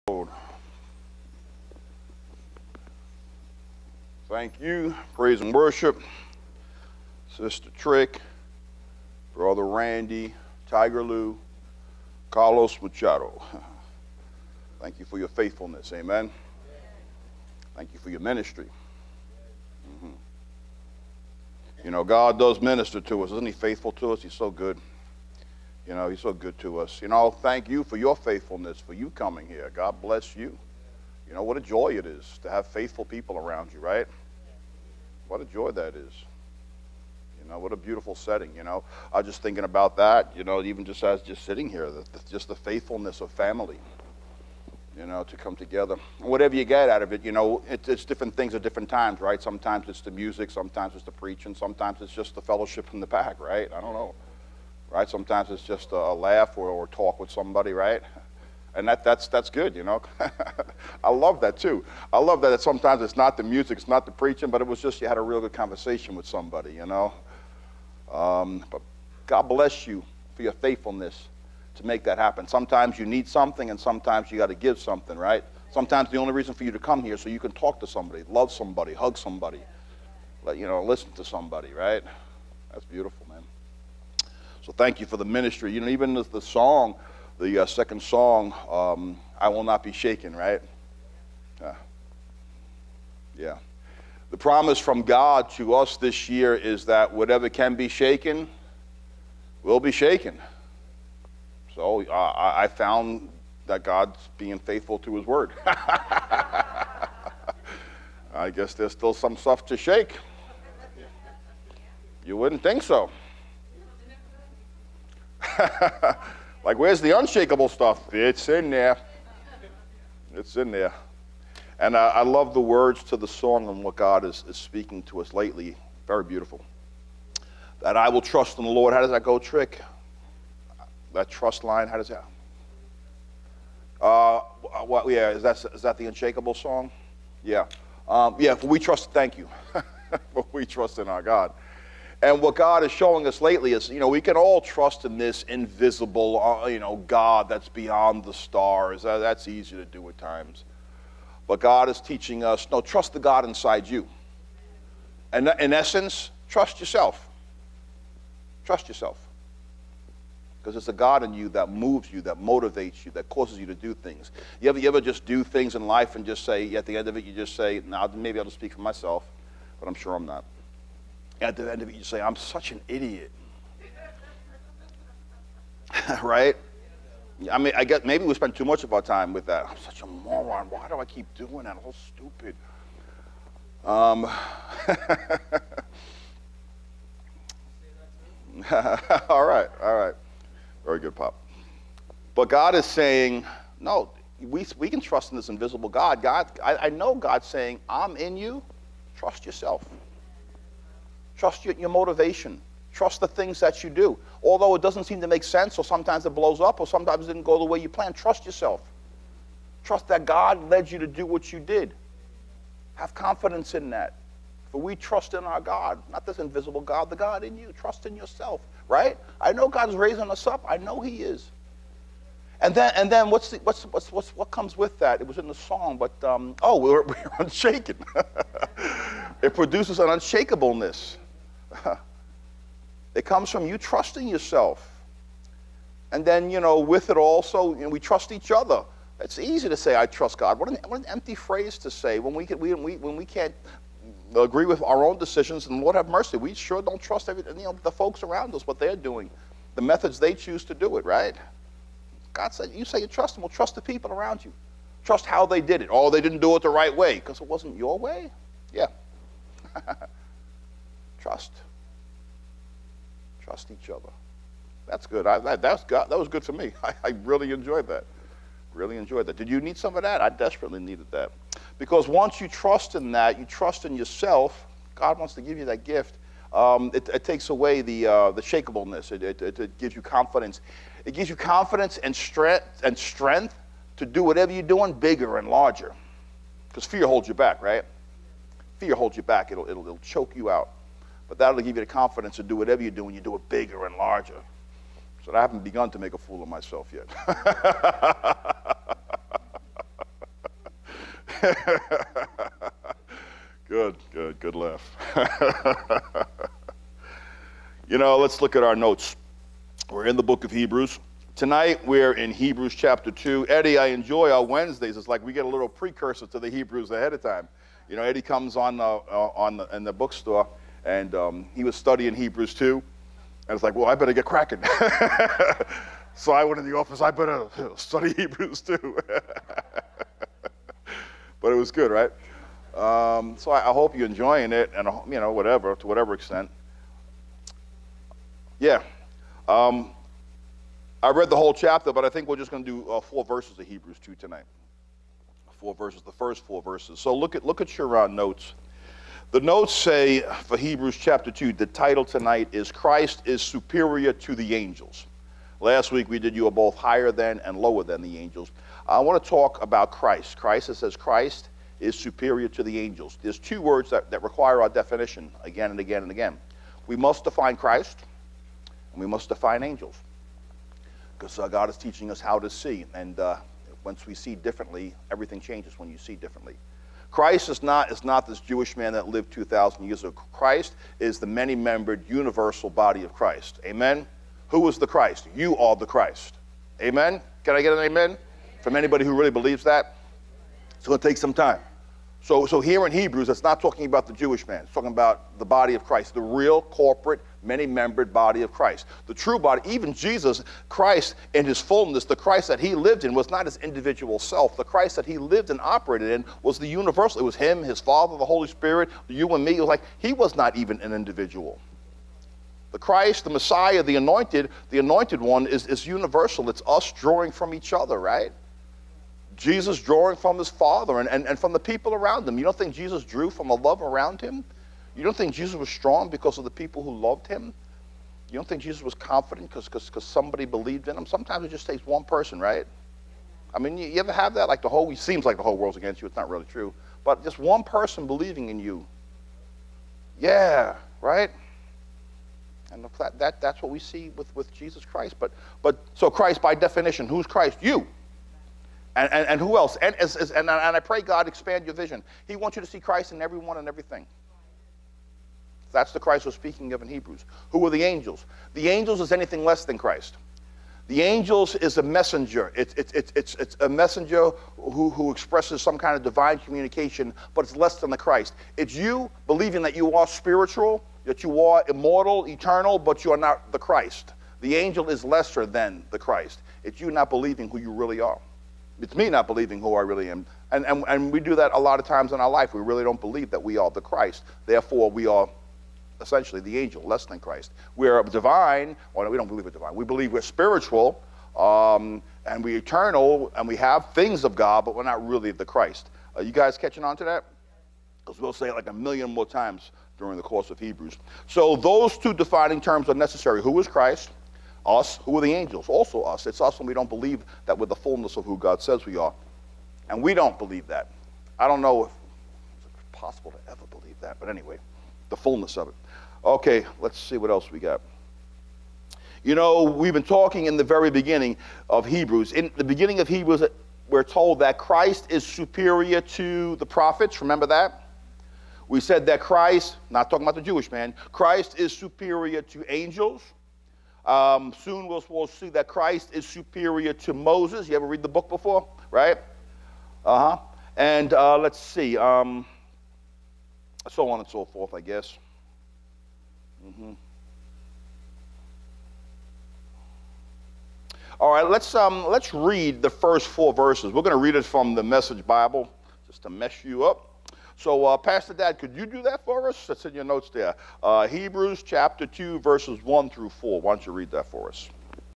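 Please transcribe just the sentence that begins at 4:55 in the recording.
So I haven't begun to make a fool of myself yet.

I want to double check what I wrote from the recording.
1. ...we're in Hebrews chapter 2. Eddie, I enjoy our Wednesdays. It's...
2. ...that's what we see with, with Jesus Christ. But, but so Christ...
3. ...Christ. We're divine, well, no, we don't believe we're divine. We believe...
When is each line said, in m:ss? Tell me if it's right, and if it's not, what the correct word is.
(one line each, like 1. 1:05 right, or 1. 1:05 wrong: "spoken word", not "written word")
1. 5:11 right
2. 7:23 right
3. 8:07 right.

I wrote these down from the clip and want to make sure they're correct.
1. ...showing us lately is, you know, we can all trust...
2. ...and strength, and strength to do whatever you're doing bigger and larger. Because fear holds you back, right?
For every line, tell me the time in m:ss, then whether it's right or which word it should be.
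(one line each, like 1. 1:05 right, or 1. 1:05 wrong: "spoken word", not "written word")
1. 2:22 right
2. 4:41 right.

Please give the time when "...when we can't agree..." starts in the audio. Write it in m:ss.
4:02.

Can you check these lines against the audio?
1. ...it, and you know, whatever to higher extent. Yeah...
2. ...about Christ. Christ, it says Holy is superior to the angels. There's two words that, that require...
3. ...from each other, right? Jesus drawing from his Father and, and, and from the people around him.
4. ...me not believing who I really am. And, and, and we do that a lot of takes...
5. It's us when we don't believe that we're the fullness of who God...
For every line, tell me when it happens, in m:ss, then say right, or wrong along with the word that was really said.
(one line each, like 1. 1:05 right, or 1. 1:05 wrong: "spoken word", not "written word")
1. 5:34 wrong: "whatever", not "higher"
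2. 5:59 wrong: "Christ", not "Holy"
3. 6:57 right
4. 7:58 wrong: "times", not "takes"
5. 8:26 right.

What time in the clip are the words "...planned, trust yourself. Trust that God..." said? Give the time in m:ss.
3:27.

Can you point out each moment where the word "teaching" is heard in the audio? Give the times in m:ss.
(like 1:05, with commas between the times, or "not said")
2:31, 6:11.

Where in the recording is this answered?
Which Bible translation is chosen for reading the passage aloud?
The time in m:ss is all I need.
9:14.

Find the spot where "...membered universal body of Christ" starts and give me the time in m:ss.
6:21.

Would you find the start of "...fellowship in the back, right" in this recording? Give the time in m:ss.
0:52.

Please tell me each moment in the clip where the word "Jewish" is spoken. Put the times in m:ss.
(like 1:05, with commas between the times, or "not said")
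6:18, 6:34, 8:50.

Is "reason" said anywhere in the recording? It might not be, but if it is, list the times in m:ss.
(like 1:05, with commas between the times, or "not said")
1:16.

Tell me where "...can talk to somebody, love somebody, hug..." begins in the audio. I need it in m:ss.
1:17.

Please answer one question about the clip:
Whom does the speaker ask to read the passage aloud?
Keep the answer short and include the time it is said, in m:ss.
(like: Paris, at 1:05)
Pastor Dad, at 9:17.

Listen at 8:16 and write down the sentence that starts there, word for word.
Are uh, you guys catching on to that?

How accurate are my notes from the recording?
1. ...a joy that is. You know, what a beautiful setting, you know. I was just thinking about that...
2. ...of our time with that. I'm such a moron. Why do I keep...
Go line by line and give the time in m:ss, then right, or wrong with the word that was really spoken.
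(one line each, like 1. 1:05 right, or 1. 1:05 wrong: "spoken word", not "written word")
1. 0:35 right
2. 2:58 right.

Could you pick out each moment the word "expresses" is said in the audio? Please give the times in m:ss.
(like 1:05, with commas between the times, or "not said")
7:45.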